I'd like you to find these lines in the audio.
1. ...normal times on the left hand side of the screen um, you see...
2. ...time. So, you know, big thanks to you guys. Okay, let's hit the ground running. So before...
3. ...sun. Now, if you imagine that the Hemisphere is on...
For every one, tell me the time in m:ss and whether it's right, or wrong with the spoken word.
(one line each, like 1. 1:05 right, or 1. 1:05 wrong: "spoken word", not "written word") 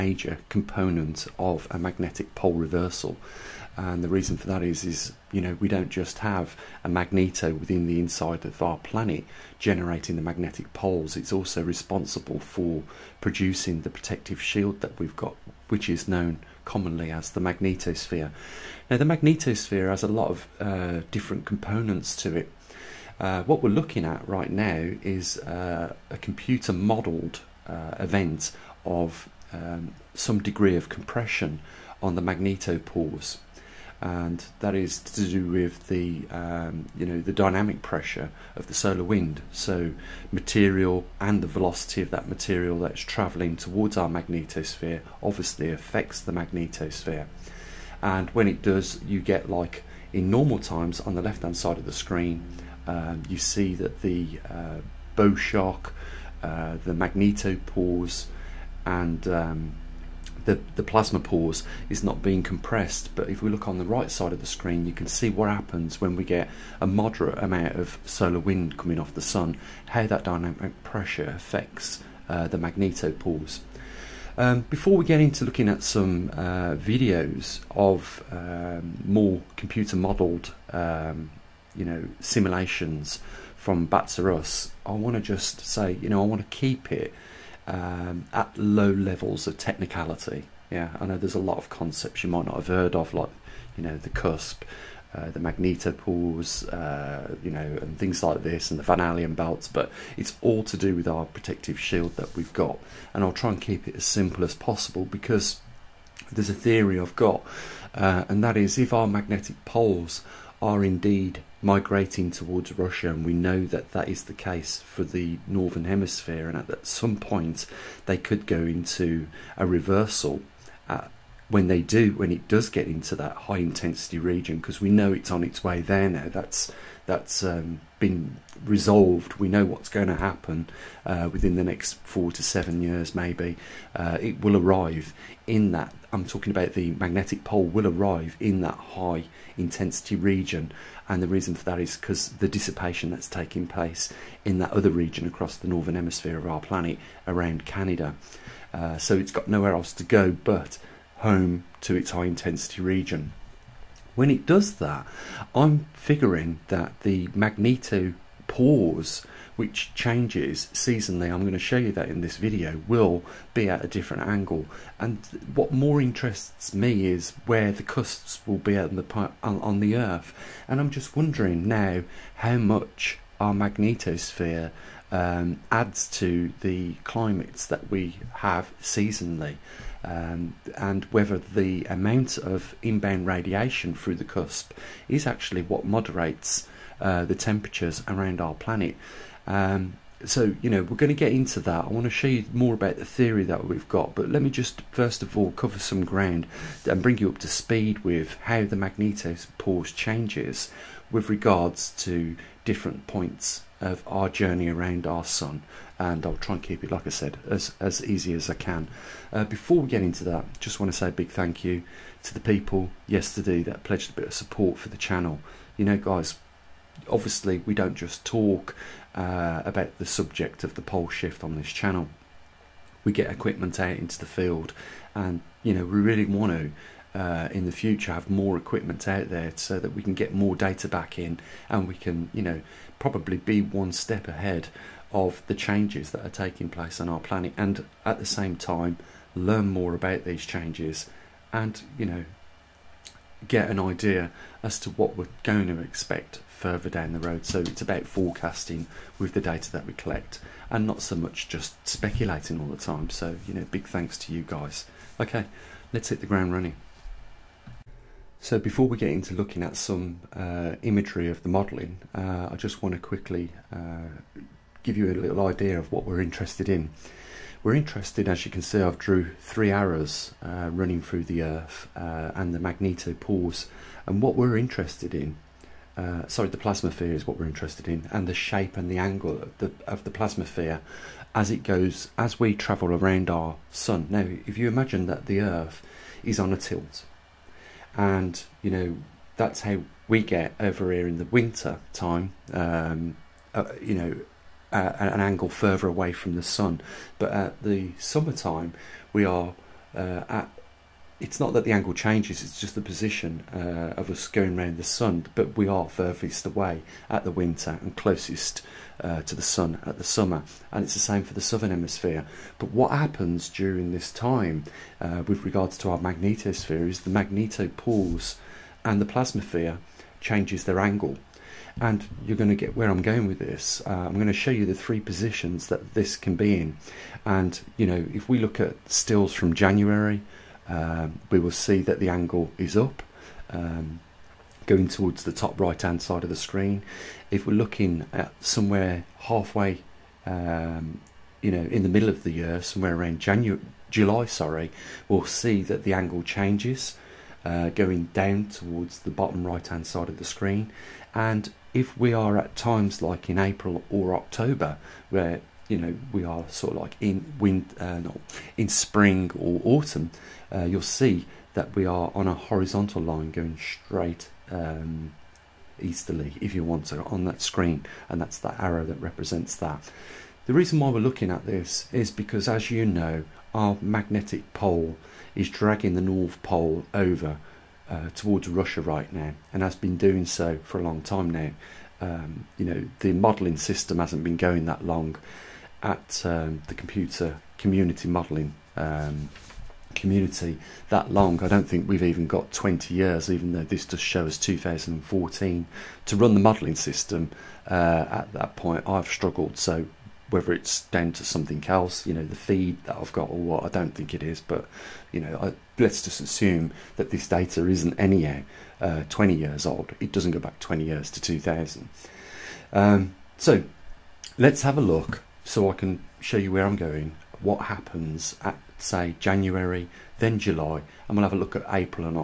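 1. 0:50 right
2. 4:12 right
3. 4:43 wrong: "Earth", not "Hemisphere".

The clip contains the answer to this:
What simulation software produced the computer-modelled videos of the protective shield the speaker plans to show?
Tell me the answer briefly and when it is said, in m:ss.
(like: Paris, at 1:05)
BATS-R-US, at 1:23.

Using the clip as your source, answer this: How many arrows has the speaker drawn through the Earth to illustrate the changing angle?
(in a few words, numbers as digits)
3.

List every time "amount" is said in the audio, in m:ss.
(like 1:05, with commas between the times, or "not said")
1:07, 3:01.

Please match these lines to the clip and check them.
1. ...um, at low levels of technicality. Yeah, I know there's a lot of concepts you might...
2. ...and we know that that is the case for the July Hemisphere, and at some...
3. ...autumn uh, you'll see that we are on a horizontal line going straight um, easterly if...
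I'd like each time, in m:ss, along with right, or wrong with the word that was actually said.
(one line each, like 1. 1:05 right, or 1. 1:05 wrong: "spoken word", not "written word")
1. 1:27 right
2. 1:53 wrong: "Northern", not "July"
3. 5:59 right.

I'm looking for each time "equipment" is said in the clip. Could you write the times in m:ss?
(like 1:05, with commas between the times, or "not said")
3:43, 3:48.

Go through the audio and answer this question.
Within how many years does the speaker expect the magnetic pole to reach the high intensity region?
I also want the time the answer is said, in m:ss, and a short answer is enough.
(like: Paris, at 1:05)
4 to 7, at 2:12.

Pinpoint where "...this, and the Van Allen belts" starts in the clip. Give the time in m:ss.
1:38.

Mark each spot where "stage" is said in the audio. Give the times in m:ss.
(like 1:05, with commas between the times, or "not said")
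not said.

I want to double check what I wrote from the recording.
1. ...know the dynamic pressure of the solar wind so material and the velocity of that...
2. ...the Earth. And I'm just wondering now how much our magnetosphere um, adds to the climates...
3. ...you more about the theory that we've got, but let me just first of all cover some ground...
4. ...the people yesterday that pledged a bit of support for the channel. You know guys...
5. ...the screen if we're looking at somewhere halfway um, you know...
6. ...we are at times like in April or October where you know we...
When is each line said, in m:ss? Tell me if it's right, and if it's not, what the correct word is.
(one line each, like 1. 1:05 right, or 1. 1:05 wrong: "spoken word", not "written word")
1. 0:37 right
2. 2:49 right
3. 3:12 right
4. 3:32 right
5. 5:36 right
6. 5:51 right.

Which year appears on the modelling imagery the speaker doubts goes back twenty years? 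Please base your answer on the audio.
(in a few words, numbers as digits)
2014.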